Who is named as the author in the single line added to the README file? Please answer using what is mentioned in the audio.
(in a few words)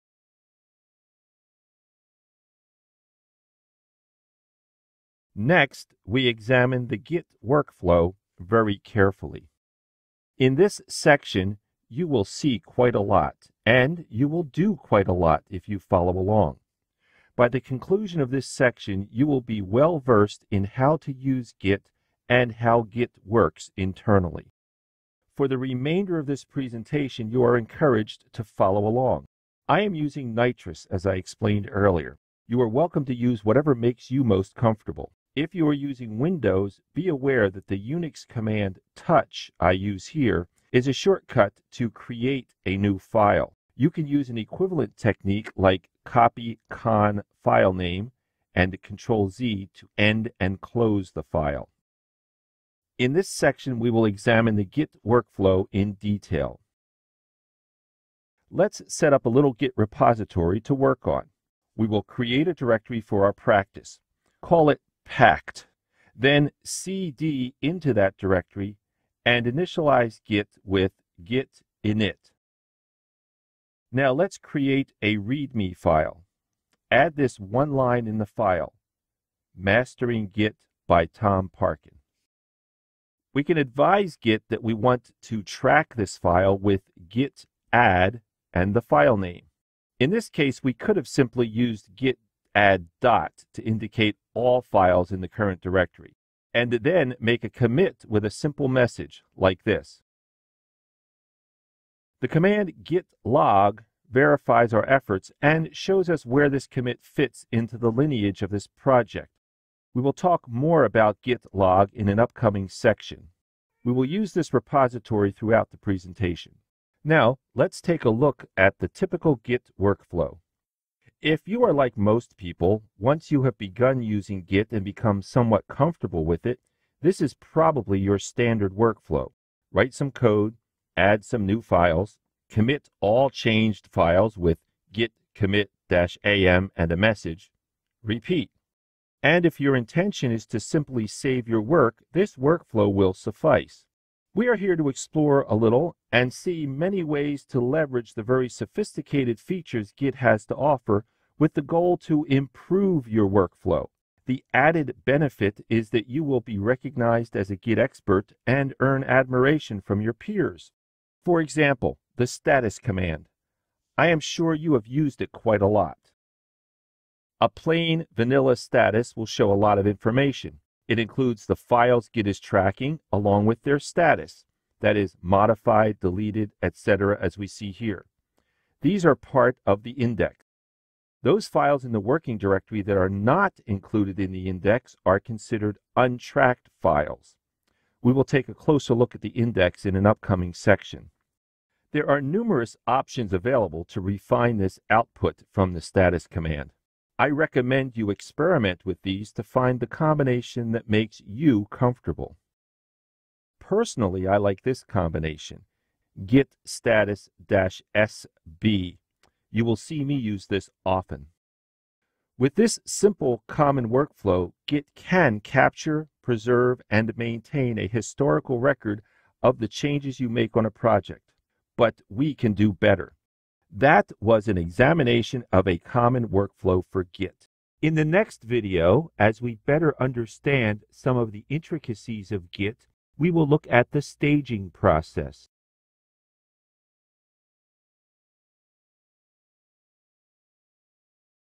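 Tom Parkin.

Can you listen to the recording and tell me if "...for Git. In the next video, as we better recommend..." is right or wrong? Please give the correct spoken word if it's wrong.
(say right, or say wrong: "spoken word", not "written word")
wrong: "understand", not "recommend".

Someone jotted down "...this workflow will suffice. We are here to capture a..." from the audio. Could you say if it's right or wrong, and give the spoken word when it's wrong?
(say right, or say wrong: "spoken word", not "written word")
wrong: "explore", not "capture".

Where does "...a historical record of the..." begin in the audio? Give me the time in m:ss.
3:37.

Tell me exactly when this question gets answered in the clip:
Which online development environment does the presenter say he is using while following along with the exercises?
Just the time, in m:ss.
0:30.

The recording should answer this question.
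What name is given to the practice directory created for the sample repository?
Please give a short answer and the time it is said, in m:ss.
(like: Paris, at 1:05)
packed, at 1:05.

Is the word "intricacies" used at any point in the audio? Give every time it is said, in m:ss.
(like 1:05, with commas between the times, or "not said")
3:51.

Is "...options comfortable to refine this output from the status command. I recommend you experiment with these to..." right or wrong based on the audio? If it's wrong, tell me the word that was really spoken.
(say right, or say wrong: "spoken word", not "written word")
wrong: "available", not "comfortable".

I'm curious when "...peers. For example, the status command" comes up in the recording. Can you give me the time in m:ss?
2:40.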